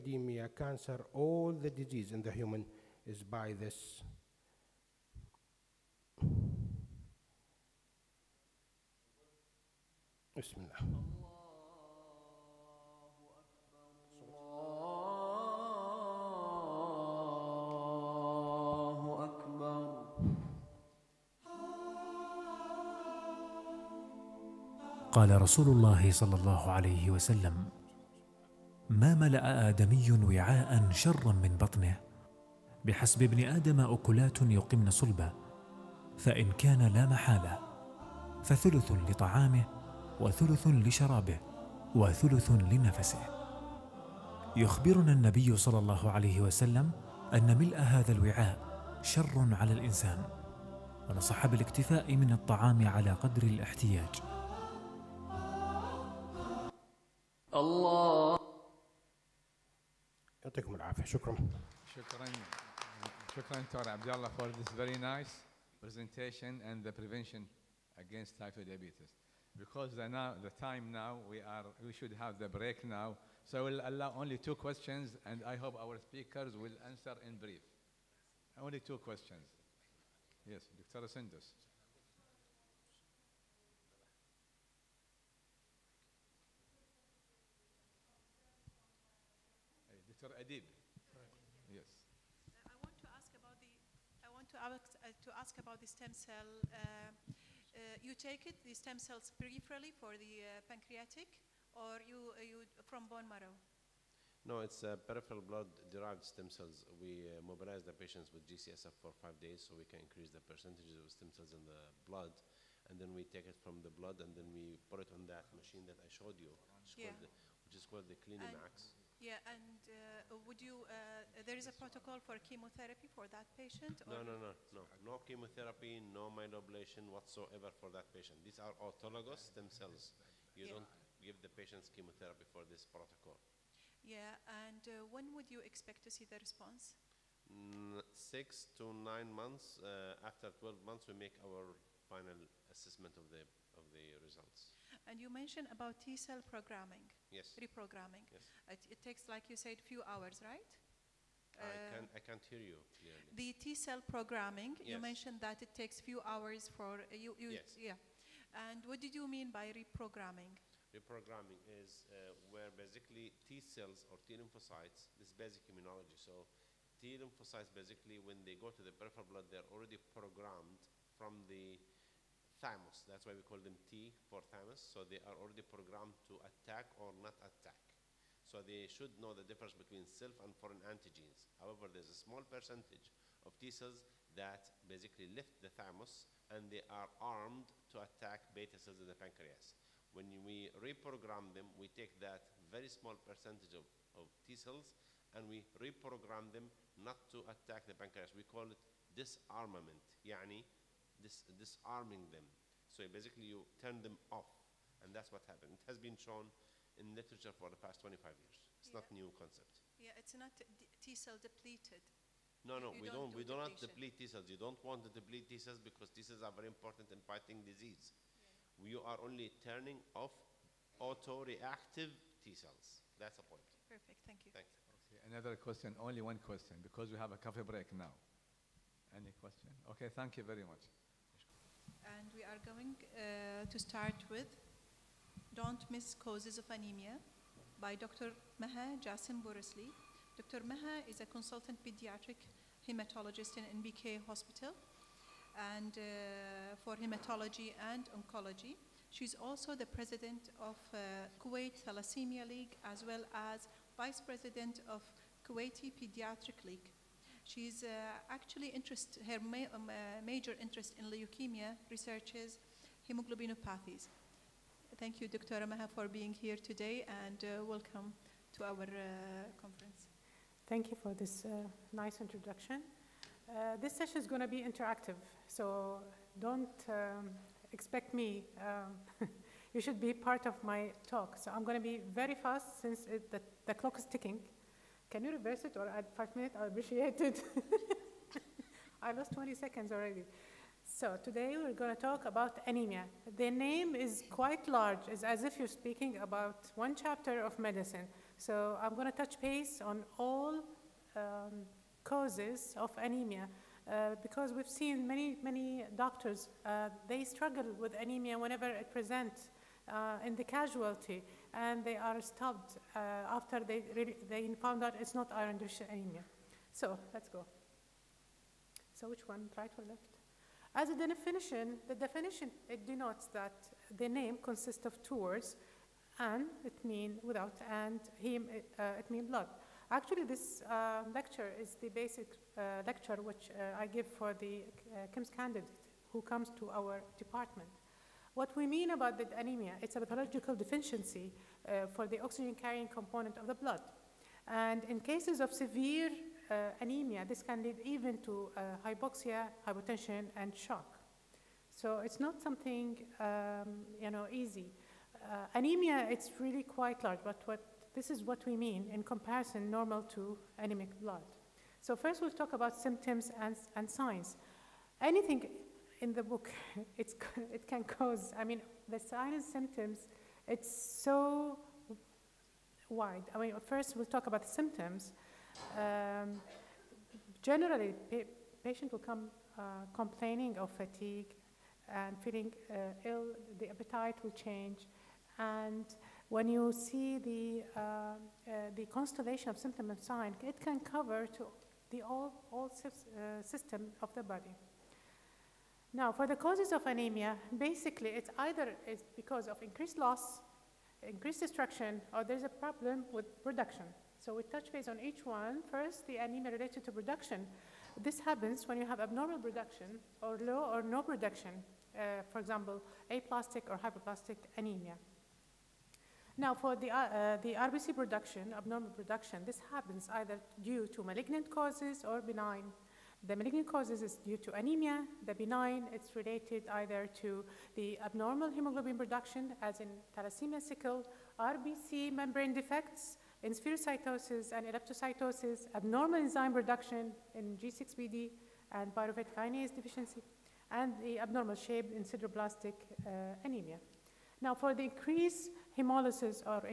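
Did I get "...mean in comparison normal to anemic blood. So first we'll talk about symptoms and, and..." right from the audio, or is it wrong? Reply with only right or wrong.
right.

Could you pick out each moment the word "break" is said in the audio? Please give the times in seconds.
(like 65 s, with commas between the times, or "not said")
72 s, 227 s.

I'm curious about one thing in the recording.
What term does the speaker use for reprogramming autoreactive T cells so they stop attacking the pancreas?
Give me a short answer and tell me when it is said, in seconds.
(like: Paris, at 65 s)
Disarmament, at 199 s.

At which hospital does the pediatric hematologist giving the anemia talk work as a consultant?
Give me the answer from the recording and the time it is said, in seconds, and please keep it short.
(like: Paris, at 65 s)
NBK Hospital, at 243 s.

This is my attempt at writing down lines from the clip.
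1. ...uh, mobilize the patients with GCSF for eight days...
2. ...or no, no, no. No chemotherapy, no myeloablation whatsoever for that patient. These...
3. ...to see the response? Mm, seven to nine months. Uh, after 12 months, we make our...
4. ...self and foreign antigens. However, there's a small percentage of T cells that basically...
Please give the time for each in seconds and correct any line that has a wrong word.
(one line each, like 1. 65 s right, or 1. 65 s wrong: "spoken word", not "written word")
1. 107 s wrong: "five", not "eight"
2. 124 s right
3. 136 s wrong: "six", not "seven"
4. 180 s right.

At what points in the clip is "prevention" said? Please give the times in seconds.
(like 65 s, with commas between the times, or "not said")
66 s.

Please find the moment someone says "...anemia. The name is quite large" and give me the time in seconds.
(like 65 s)
292 s.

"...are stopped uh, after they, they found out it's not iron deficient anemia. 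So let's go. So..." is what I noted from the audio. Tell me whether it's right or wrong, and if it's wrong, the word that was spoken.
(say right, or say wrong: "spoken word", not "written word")
right.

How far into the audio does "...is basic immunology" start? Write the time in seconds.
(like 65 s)
165 s.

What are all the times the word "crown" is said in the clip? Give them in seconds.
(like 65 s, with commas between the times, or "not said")
not said.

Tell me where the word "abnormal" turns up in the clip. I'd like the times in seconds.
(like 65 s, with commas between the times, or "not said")
409 s, 418 s, 428 s, 435 s, 441 s.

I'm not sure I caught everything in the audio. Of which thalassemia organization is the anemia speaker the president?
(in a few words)
Kuwait Thalassemia League.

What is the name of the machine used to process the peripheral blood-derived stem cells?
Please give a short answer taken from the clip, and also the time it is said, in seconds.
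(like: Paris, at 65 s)
CliniMACS, at 118 s.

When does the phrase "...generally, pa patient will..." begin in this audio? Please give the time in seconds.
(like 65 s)
377 s.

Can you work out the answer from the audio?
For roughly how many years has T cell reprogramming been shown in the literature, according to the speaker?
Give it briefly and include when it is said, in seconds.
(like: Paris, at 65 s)
25 years, at 208 s.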